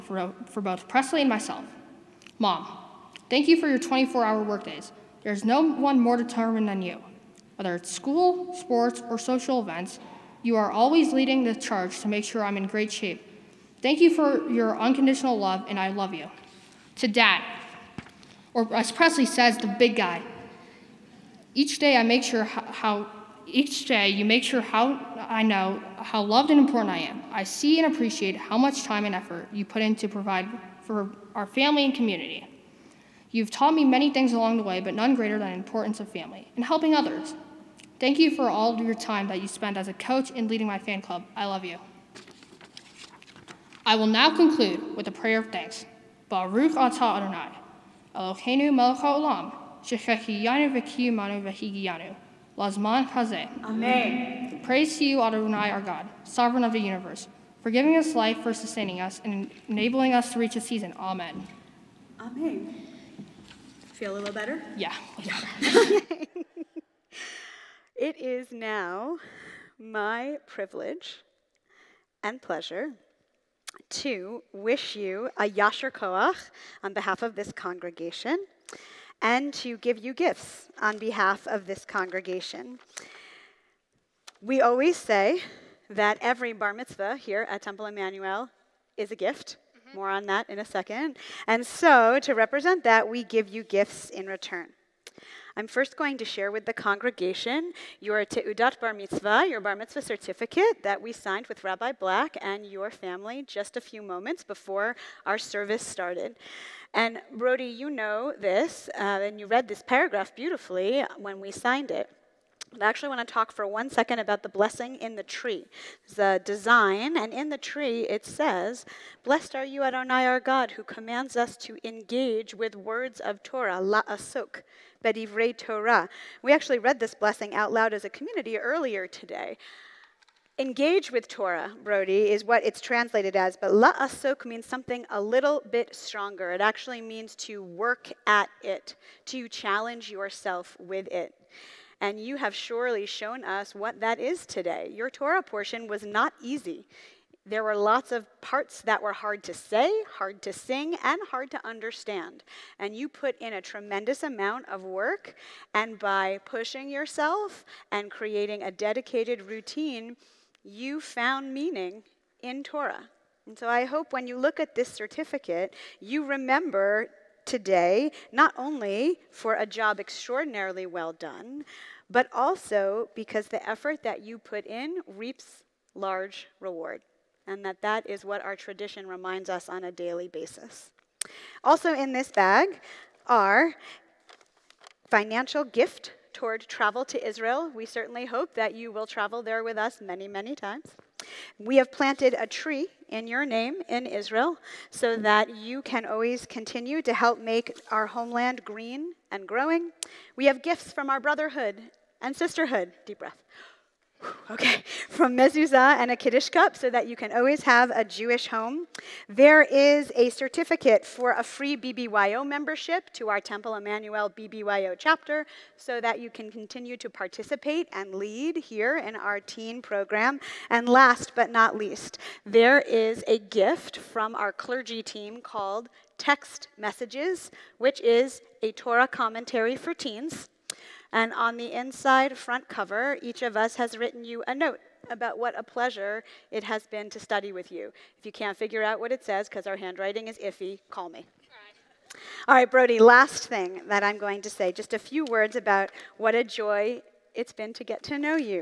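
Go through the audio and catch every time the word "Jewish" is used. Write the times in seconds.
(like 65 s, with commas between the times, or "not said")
208 s.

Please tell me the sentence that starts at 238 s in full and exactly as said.
If you can't figure out what it says, because our handwriting is iffy, call me.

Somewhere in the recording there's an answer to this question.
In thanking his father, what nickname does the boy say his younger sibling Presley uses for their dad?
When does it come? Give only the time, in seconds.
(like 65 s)
19 s.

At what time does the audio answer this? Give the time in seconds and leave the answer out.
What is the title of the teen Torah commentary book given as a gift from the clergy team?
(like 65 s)
226 s.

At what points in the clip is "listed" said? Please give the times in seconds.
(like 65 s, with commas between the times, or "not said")
not said.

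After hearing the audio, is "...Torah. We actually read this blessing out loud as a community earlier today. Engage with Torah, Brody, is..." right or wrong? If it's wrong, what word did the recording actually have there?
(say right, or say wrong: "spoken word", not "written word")
right.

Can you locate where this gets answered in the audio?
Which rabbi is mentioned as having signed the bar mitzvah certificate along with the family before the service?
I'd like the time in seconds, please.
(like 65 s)
101 s.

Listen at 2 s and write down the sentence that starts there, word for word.
Mom, Thank you for your 24 hour workdays.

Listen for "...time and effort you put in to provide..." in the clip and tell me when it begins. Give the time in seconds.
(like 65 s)
28 s.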